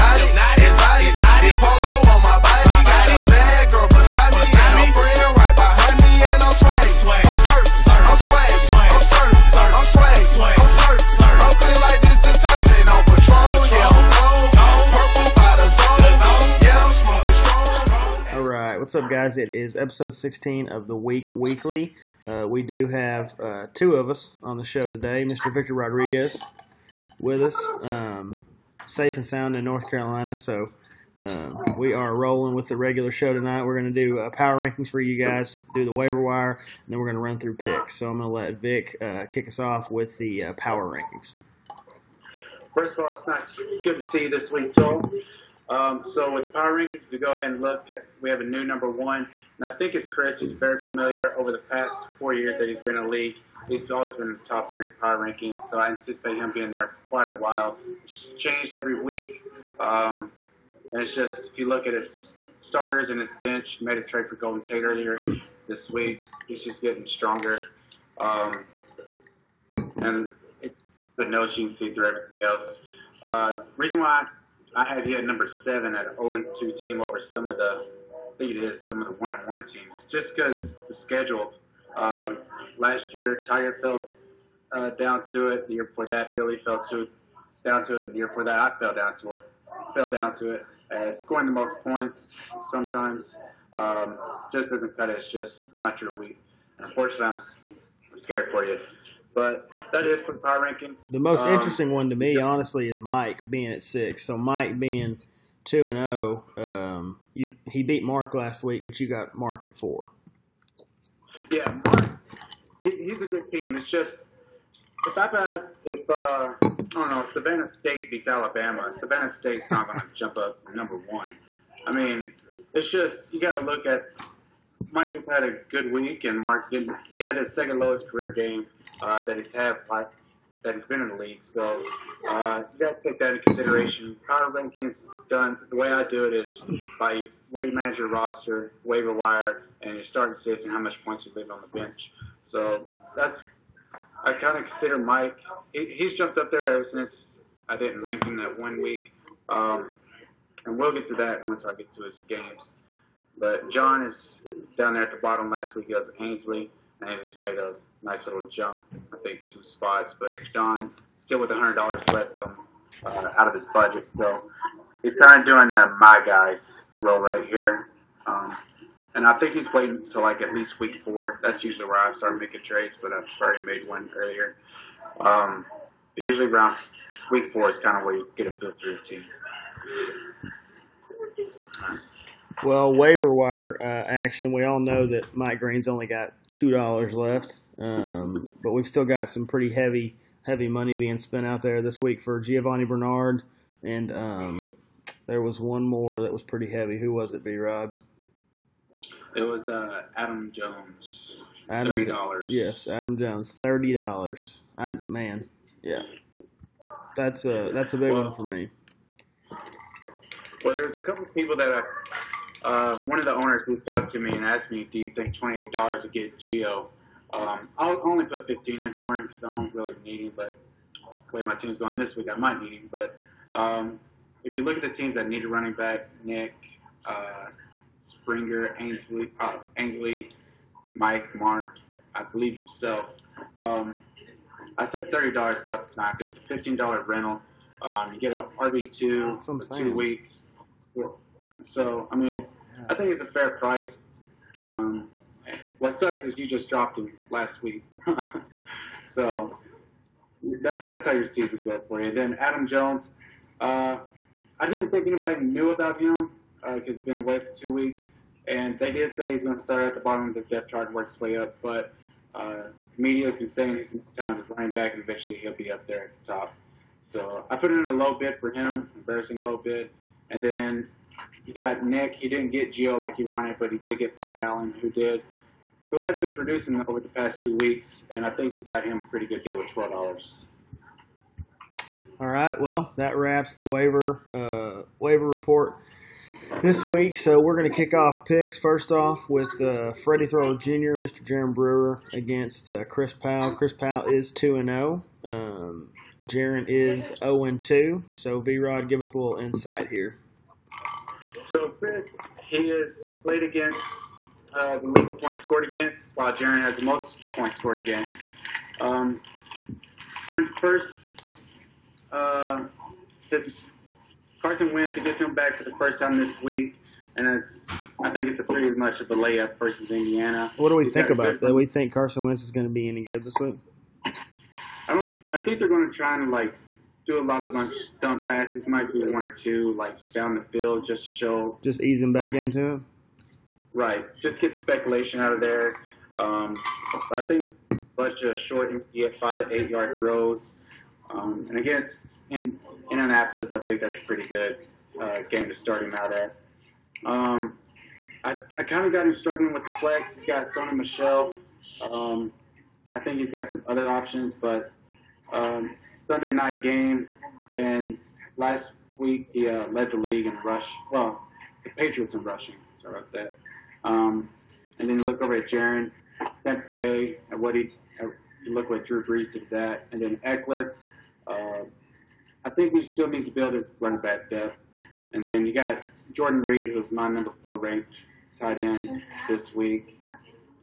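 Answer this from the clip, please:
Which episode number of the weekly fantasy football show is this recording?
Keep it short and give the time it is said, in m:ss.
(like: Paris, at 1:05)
16, at 0:20.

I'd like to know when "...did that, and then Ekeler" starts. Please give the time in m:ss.
6:09.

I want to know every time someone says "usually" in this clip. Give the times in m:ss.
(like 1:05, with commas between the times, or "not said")
2:51, 2:56.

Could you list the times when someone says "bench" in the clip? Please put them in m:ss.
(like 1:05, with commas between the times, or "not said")
1:03, 2:21.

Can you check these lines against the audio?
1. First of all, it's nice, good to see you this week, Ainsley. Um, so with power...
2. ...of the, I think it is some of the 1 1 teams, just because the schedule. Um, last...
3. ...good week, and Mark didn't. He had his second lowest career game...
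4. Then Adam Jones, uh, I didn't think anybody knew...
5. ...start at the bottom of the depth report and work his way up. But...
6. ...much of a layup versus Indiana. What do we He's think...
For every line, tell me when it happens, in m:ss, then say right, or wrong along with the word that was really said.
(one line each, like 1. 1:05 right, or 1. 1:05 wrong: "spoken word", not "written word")
1. 0:42 wrong: "Joel", not "Ainsley"
2. 1:17 right
3. 2:05 right
4. 4:12 right
5. 4:19 wrong: "chart", not "report"
6. 5:18 right.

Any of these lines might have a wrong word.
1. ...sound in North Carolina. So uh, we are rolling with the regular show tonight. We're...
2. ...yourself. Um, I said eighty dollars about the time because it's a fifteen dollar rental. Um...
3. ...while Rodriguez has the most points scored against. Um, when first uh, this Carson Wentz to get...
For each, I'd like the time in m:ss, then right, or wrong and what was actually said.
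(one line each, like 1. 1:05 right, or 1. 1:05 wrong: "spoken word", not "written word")
1. 0:29 right
2. 3:52 wrong: "thirty", not "eighty"
3. 5:06 wrong: "Jaron", not "Rodriguez".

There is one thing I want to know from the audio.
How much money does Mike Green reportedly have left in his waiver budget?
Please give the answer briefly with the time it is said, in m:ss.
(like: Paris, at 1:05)
$2, at 3:06.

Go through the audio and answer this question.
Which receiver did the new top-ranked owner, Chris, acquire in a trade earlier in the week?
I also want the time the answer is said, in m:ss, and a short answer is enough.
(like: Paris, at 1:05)
Golden Tate, at 1:04.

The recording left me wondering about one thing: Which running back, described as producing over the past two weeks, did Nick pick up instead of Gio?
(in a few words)
Buck Allen.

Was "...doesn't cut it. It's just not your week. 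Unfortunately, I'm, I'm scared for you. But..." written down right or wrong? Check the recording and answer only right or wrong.
right.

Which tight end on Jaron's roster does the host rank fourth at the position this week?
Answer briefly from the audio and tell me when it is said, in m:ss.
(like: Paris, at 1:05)
Jordan Reed, at 6:16.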